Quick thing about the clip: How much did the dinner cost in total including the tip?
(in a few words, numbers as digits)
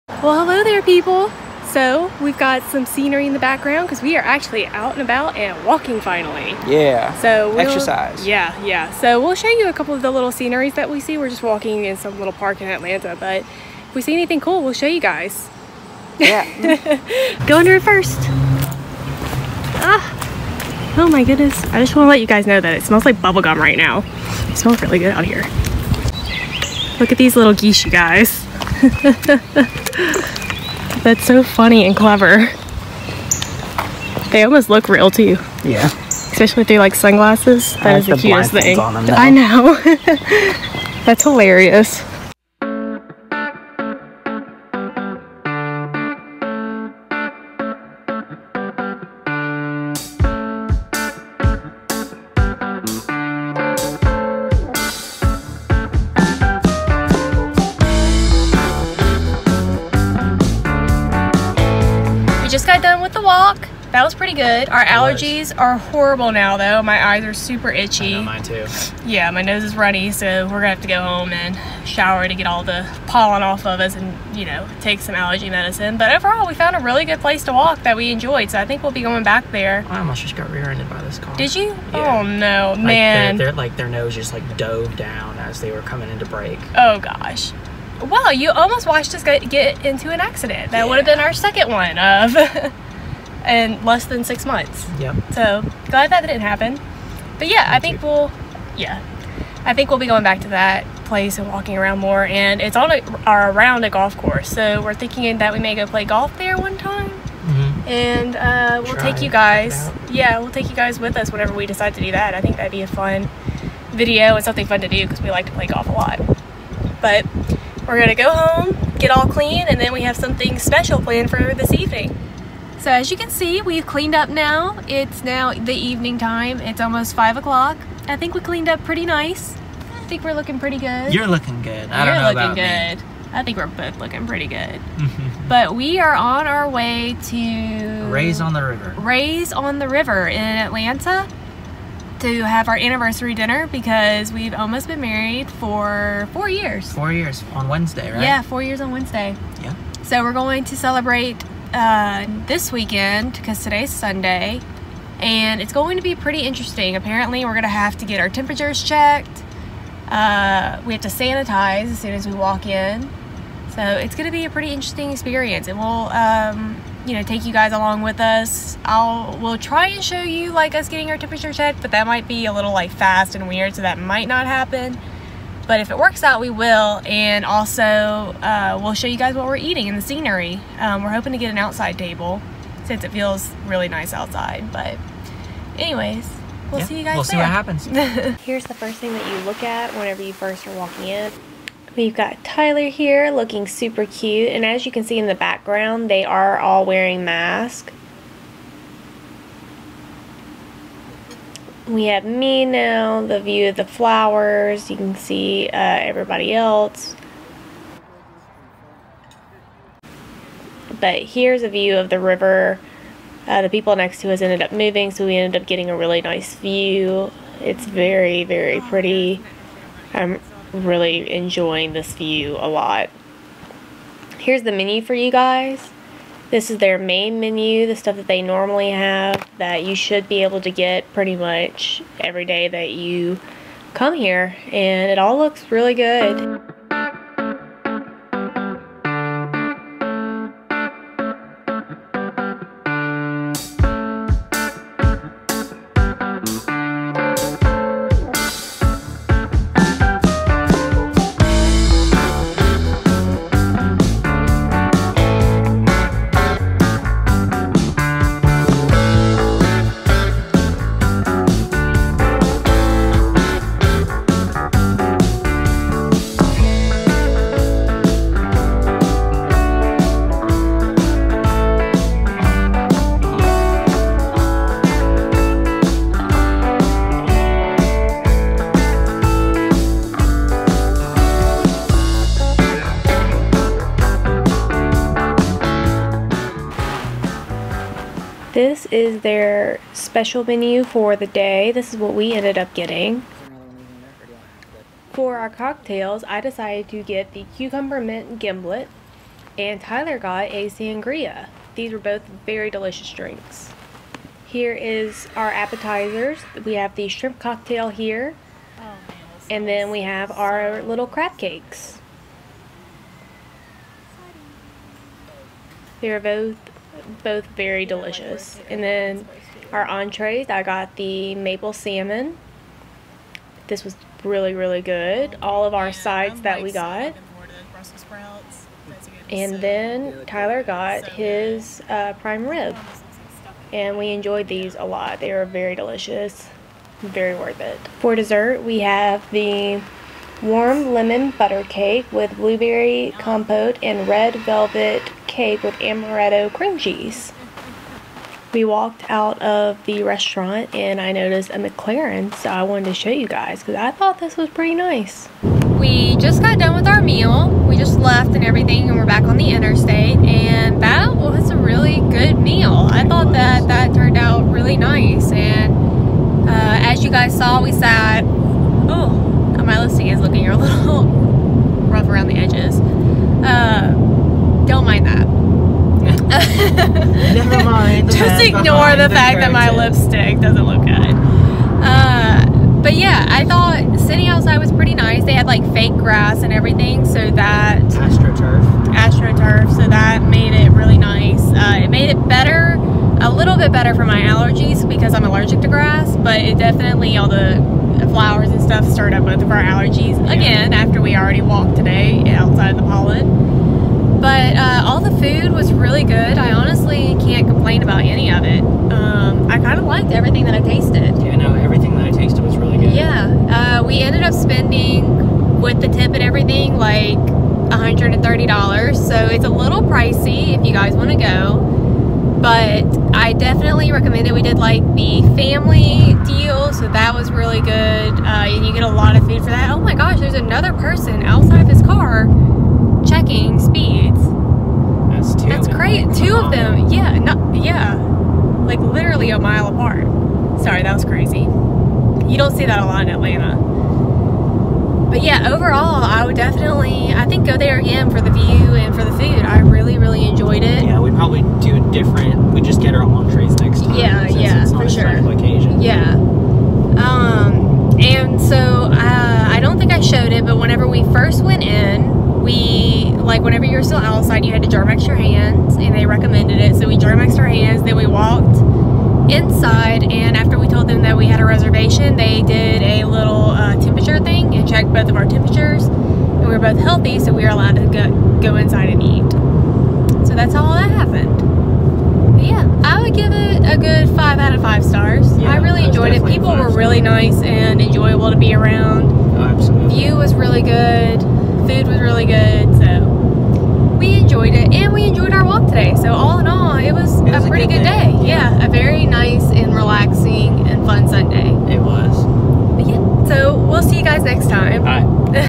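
$130.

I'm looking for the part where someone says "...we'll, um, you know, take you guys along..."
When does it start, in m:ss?
2:45.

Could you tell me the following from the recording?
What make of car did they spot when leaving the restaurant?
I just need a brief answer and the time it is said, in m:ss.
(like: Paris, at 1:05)
McLaren, at 5:51.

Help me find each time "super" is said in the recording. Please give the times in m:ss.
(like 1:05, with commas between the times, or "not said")
1:07, 3:13.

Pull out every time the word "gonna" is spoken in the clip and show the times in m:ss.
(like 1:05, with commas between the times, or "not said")
1:10, 1:57.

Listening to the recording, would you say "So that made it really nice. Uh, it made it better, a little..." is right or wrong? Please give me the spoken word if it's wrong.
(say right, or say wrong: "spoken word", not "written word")
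right.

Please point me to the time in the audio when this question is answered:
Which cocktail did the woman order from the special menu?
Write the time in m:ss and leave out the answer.
4:57.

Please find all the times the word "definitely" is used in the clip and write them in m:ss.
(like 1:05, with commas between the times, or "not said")
6:36, 7:03, 7:26.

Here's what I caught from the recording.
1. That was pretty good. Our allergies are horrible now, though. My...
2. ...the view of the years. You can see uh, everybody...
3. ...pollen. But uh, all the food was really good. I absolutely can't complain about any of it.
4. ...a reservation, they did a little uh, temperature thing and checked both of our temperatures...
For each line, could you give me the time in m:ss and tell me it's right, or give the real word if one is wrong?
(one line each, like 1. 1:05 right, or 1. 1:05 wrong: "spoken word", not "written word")
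1. 1:03 right
2. 3:23 wrong: "flowers", not "years"
3. 6:42 wrong: "honestly", not "absolutely"
4. 7:51 right.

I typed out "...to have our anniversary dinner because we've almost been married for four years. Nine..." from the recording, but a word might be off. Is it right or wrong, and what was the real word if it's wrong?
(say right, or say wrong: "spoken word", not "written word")
wrong: "Four", not "Nine".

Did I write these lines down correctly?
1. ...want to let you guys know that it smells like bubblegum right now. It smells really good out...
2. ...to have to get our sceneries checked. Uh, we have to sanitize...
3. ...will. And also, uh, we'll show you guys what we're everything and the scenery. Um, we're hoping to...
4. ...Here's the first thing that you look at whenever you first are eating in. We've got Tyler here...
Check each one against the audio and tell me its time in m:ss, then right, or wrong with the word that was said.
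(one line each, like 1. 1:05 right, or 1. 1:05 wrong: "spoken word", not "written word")
1. 0:21 right
2. 2:37 wrong: "temperatures", not "sceneries"
3. 2:56 wrong: "eating", not "everything"
4. 3:08 wrong: "walking", not "eating".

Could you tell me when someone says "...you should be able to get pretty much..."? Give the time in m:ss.
3:49.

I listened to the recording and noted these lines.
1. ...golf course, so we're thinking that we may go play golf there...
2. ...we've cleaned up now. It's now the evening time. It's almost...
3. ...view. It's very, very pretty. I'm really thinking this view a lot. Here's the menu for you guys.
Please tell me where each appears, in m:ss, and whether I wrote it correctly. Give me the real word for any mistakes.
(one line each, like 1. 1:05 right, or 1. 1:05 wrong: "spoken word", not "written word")
1. 1:43 right
2. 2:03 right
3. 3:36 wrong: "enjoying", not "thinking".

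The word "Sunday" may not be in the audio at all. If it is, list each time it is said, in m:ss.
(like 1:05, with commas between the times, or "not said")
2:33, 8:21.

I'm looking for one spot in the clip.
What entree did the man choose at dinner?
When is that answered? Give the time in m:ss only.
5:32.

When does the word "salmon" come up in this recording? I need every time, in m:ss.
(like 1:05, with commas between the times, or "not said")
5:21.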